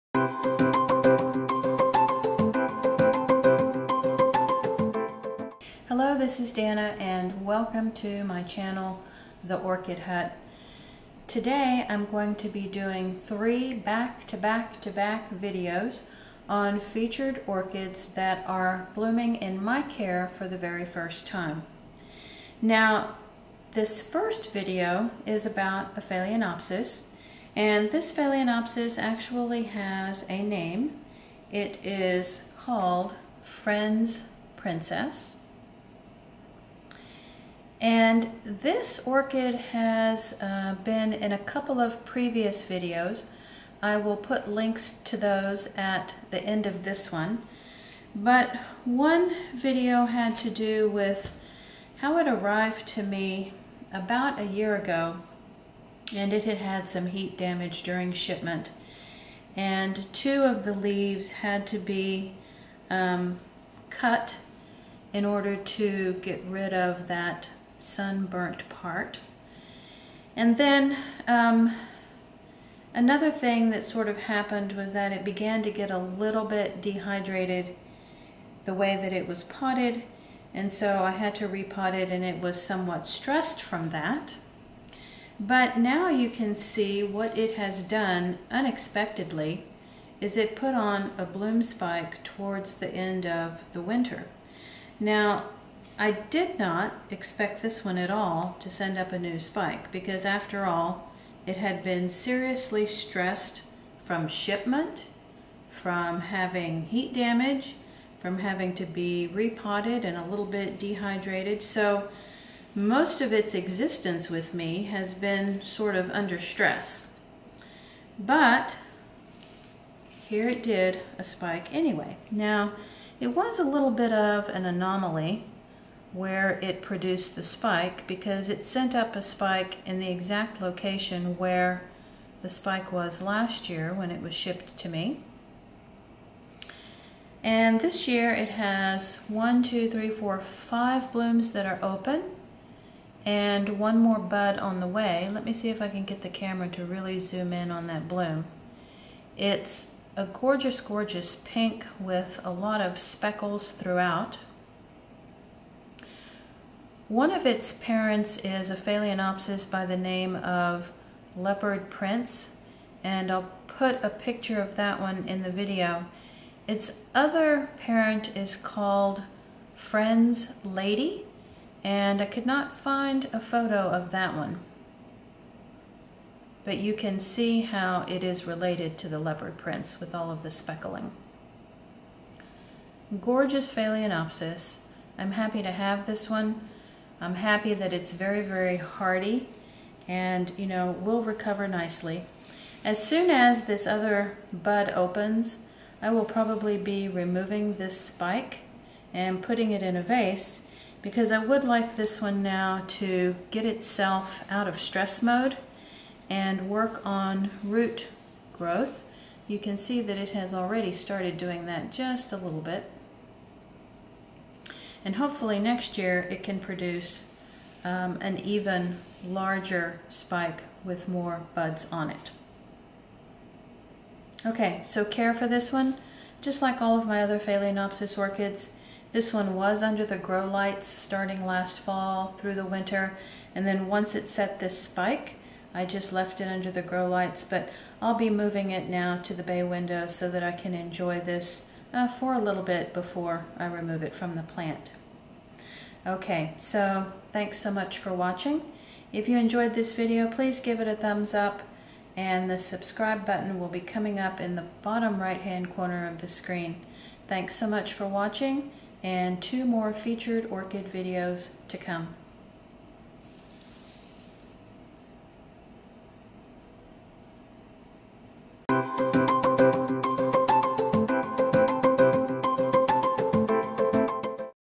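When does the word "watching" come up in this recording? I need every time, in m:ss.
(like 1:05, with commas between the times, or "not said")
4:08, 4:18.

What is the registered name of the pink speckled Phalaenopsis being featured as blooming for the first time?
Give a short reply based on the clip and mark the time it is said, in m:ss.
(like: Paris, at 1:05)
Friend's Princess, at 0:33.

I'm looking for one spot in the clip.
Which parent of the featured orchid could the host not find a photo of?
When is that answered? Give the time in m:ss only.
2:49.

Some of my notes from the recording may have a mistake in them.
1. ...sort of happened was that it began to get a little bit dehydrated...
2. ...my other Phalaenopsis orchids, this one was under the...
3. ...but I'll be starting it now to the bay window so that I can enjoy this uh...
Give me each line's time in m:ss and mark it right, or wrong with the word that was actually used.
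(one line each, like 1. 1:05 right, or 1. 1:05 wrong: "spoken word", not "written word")
1. 1:13 right
2. 3:47 right
3. 3:57 wrong: "moving", not "starting".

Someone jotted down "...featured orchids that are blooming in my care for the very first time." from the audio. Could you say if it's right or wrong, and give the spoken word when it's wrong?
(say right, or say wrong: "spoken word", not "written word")
right.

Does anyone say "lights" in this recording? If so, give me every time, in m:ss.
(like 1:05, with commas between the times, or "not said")
3:50, 3:57.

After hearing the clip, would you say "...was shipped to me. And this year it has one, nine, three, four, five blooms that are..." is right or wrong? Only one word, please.
wrong.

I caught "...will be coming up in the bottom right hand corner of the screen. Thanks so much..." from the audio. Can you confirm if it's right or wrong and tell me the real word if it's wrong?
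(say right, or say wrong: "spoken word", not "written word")
right.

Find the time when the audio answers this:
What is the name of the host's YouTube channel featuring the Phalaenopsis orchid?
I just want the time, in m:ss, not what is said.
0:09.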